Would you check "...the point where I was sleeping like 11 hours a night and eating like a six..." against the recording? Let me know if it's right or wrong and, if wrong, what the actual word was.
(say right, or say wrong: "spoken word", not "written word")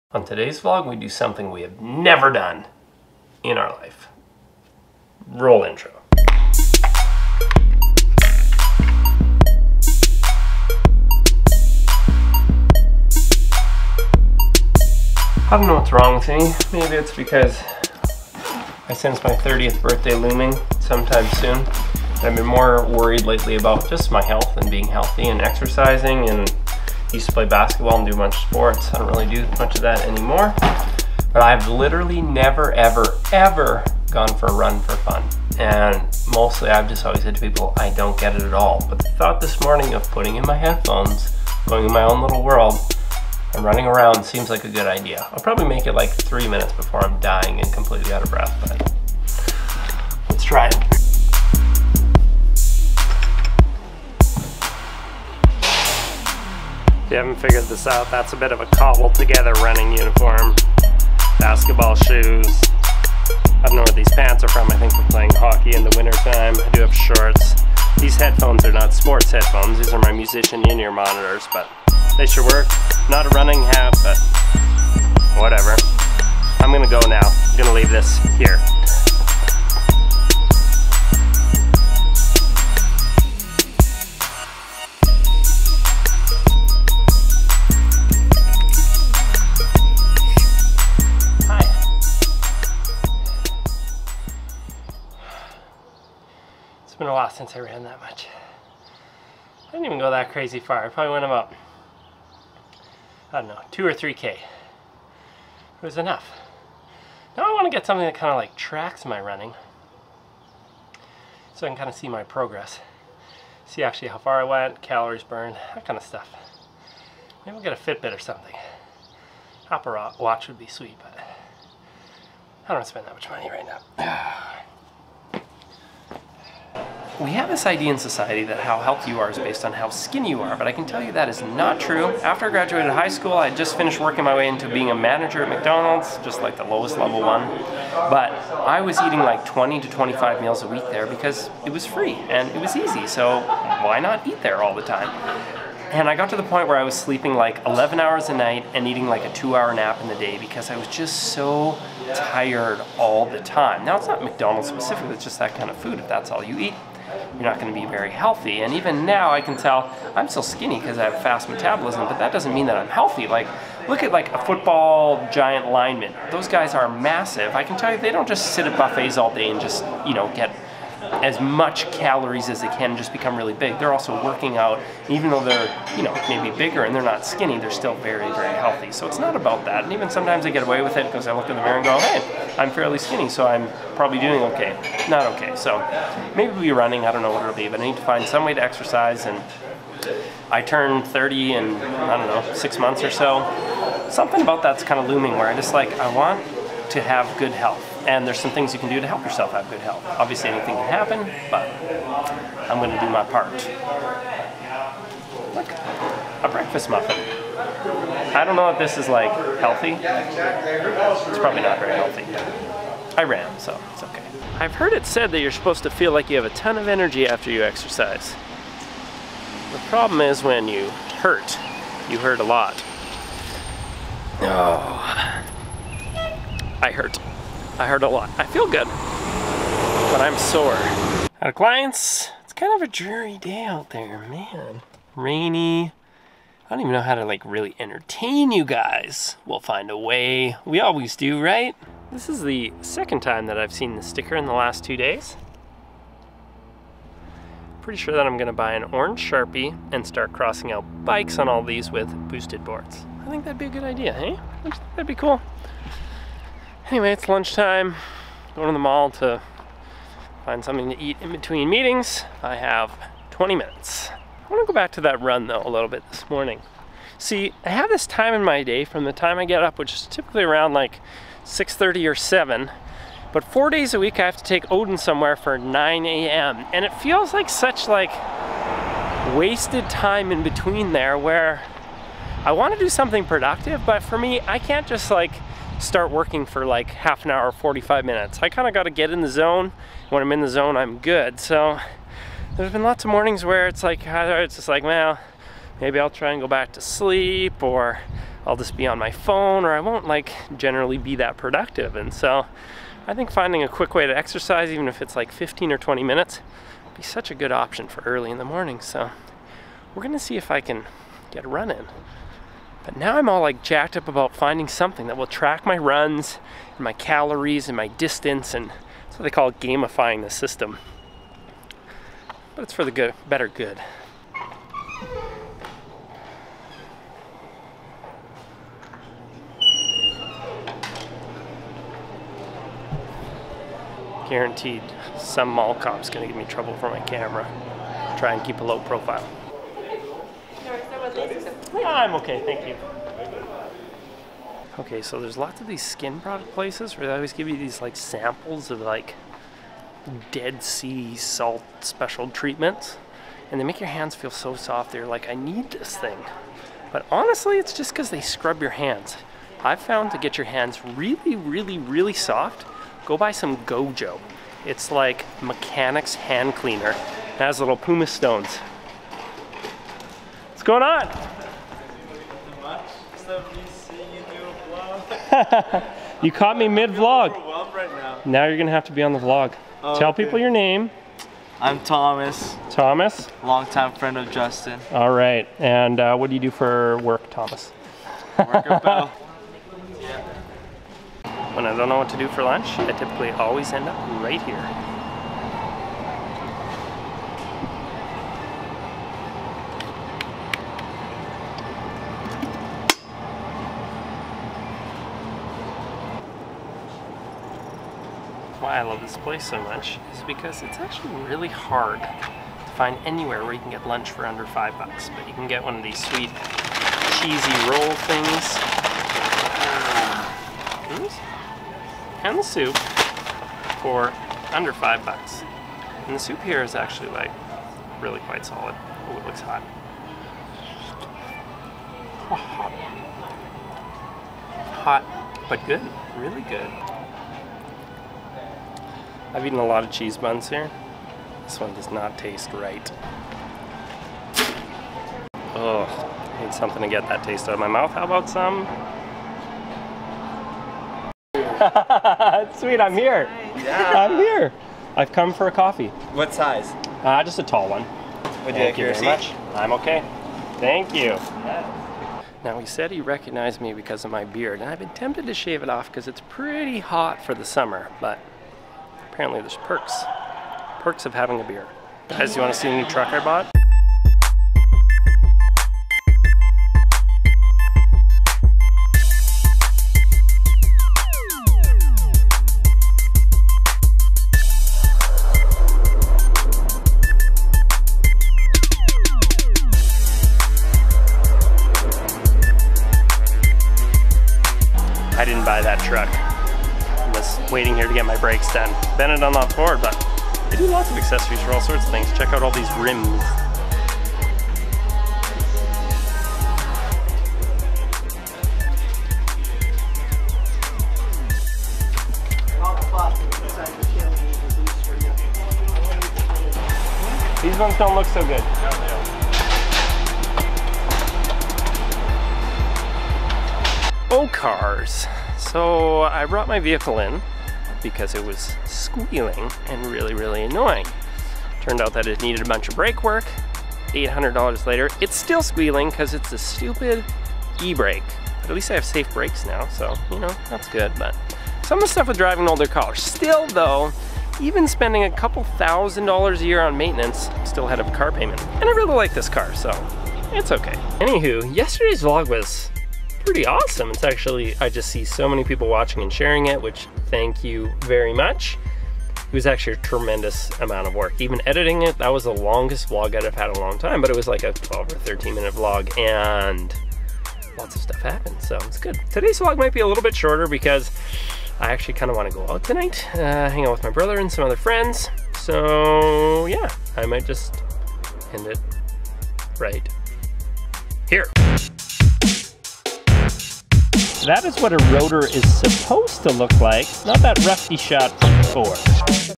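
wrong: "two", not "six".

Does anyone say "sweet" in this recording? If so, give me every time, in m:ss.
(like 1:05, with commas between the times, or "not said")
2:00, 6:55, 7:32.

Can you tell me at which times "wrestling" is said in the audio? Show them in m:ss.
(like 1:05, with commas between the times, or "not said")
not said.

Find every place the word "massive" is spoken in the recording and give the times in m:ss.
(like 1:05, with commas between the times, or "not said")
2:46.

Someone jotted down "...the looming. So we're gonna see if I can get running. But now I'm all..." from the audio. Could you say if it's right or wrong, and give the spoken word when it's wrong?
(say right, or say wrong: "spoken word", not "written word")
wrong: "morning", not "looming".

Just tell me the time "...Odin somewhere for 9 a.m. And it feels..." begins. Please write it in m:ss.
4:34.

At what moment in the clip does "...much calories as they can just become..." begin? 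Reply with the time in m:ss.
2:51.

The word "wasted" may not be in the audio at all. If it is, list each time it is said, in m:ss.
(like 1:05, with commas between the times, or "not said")
4:39.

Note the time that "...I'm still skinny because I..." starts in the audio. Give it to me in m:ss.
2:40.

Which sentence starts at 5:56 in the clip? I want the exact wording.
But honestly, it's just because they scrub your hands.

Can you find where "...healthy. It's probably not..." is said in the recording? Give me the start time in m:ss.
3:29.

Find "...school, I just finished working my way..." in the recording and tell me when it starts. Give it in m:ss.
2:13.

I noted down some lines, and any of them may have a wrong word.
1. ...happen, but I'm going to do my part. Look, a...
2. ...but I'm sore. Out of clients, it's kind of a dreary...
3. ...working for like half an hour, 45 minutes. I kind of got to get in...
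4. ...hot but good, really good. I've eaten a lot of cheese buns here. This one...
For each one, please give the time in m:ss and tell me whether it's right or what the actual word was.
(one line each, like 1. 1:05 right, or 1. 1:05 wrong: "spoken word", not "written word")
1. 3:20 right
2. 3:48 right
3. 4:46 right
4. 7:15 right.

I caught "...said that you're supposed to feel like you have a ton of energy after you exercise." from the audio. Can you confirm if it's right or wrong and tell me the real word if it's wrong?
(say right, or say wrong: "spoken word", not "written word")
right.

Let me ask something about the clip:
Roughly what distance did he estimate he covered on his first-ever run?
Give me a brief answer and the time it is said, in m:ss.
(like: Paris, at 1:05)
2 or 3 km, at 1:43.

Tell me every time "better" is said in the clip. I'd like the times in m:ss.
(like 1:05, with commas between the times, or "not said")
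5:23.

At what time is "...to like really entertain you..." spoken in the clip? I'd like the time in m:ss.
3:57.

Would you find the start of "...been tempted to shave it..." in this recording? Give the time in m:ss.
7:44.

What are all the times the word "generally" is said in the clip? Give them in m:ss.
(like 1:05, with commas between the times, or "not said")
5:00.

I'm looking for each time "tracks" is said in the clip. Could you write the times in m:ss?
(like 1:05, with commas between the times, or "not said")
1:48, 5:15.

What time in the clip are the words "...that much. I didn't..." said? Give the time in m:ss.
1:37.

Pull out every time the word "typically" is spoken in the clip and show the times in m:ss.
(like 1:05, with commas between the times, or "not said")
4:30, 6:32.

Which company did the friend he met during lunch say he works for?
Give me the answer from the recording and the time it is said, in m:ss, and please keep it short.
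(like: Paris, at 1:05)
Bell, at 6:28.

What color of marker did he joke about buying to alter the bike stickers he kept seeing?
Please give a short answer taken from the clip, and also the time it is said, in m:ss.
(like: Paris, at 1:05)
Orange, at 4:08.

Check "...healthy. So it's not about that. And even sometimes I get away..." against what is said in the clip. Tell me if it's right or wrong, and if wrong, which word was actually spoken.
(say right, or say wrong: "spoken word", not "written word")
right.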